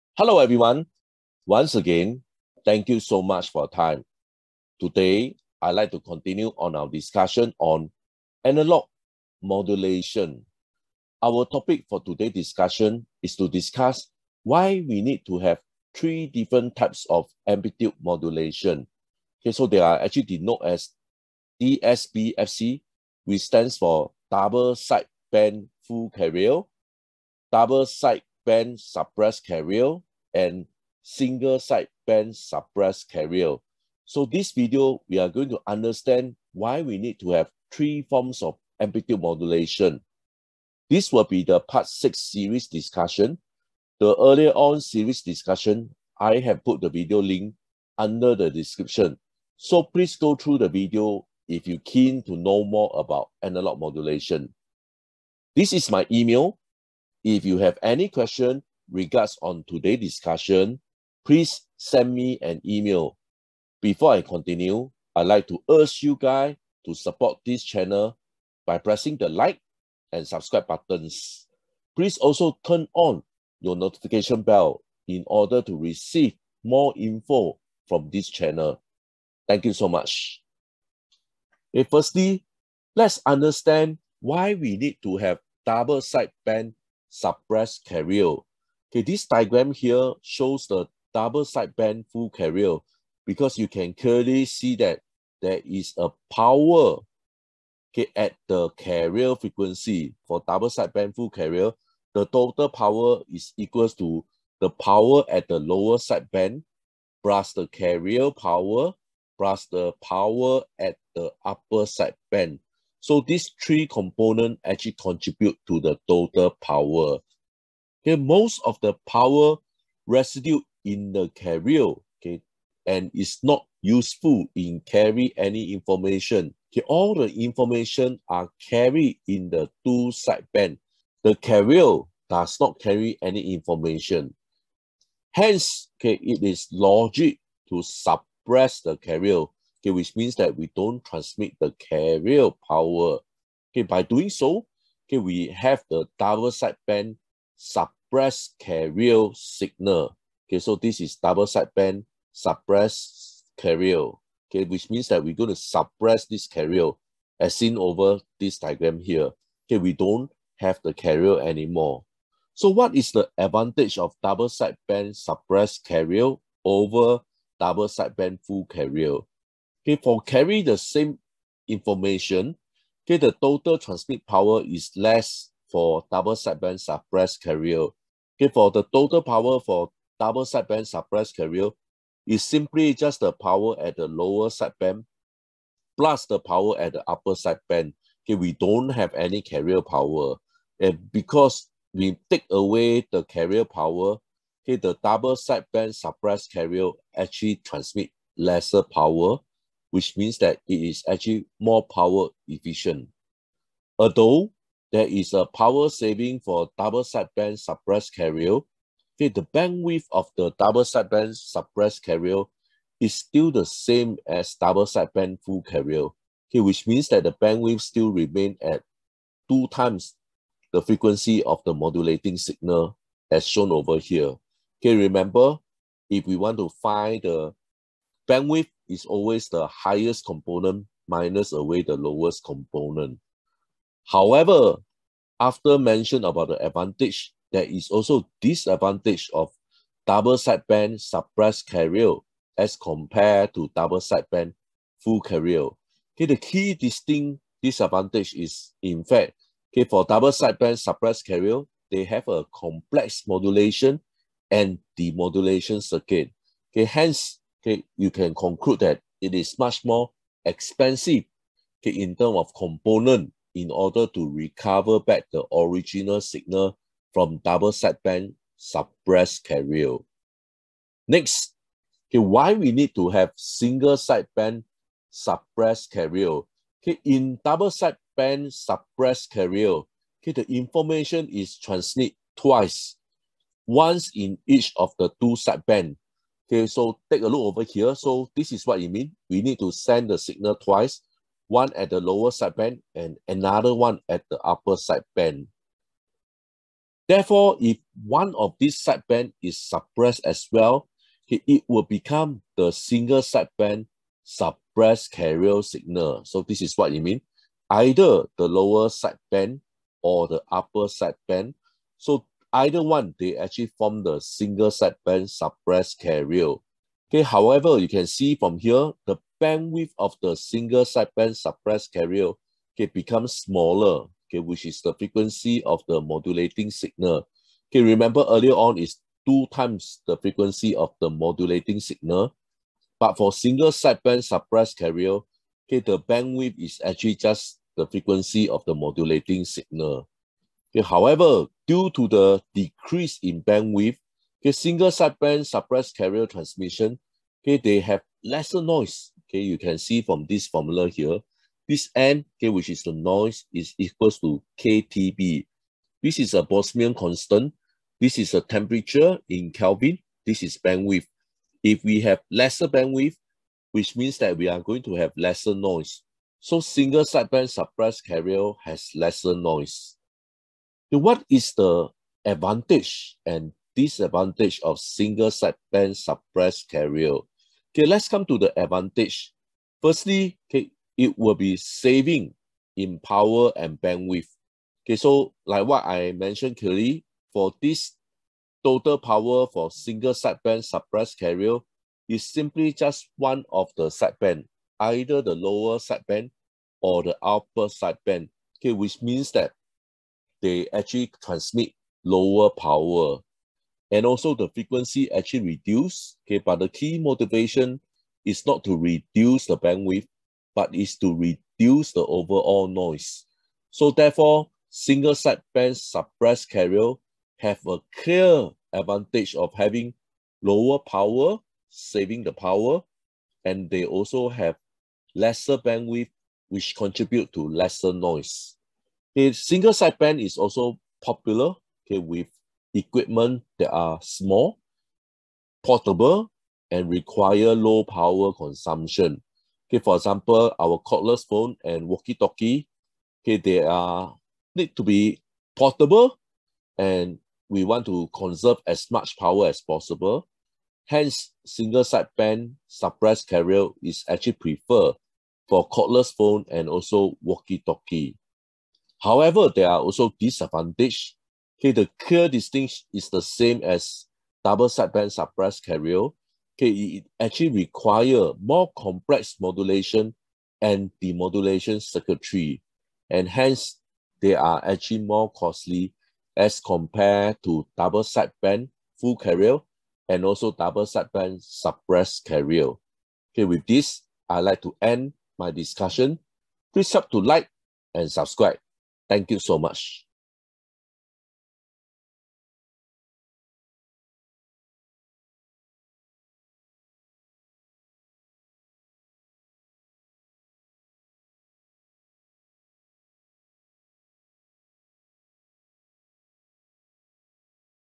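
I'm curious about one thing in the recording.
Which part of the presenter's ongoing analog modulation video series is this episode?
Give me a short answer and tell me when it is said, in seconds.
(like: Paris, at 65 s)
part six, at 41 s.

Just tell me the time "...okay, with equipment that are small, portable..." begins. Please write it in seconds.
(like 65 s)
431 s.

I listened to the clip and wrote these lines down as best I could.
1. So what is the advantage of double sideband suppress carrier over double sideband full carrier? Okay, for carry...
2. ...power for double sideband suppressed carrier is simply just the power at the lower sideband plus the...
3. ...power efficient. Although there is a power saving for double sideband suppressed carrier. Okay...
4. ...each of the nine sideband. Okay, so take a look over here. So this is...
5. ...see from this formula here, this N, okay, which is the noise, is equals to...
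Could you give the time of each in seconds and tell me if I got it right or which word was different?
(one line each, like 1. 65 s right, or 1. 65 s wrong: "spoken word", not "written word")
1. 162 s right
2. 179 s right
3. 201 s right
4. 284 s wrong: "two", not "nine"
5. 349 s right.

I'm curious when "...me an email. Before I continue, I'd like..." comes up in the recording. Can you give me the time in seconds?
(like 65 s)
62 s.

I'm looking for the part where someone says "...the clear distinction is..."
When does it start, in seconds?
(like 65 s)
461 s.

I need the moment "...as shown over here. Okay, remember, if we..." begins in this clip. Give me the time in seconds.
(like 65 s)
223 s.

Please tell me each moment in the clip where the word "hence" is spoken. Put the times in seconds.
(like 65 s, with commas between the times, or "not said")
135 s, 256 s, 450 s, 473 s.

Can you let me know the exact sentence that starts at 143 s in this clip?
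Okay, by doing so, okay, we have the double sideband suppress carrier signal.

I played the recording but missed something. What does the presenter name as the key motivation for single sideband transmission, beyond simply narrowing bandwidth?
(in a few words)
reduce the overall noise.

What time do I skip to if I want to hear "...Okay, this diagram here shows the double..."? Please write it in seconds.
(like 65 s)
88 s.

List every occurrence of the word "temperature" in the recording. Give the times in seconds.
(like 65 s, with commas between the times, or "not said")
358 s.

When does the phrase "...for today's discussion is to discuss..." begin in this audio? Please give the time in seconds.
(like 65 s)
11 s.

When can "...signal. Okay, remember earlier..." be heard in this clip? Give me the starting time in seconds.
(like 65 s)
326 s.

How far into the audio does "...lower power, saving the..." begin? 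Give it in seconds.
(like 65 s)
420 s.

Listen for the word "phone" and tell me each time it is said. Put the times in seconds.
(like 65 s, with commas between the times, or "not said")
441 s, 456 s.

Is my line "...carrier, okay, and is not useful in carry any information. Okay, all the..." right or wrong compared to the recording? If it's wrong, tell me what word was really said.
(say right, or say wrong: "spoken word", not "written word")
right.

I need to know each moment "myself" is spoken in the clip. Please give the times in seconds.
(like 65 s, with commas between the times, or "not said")
not said.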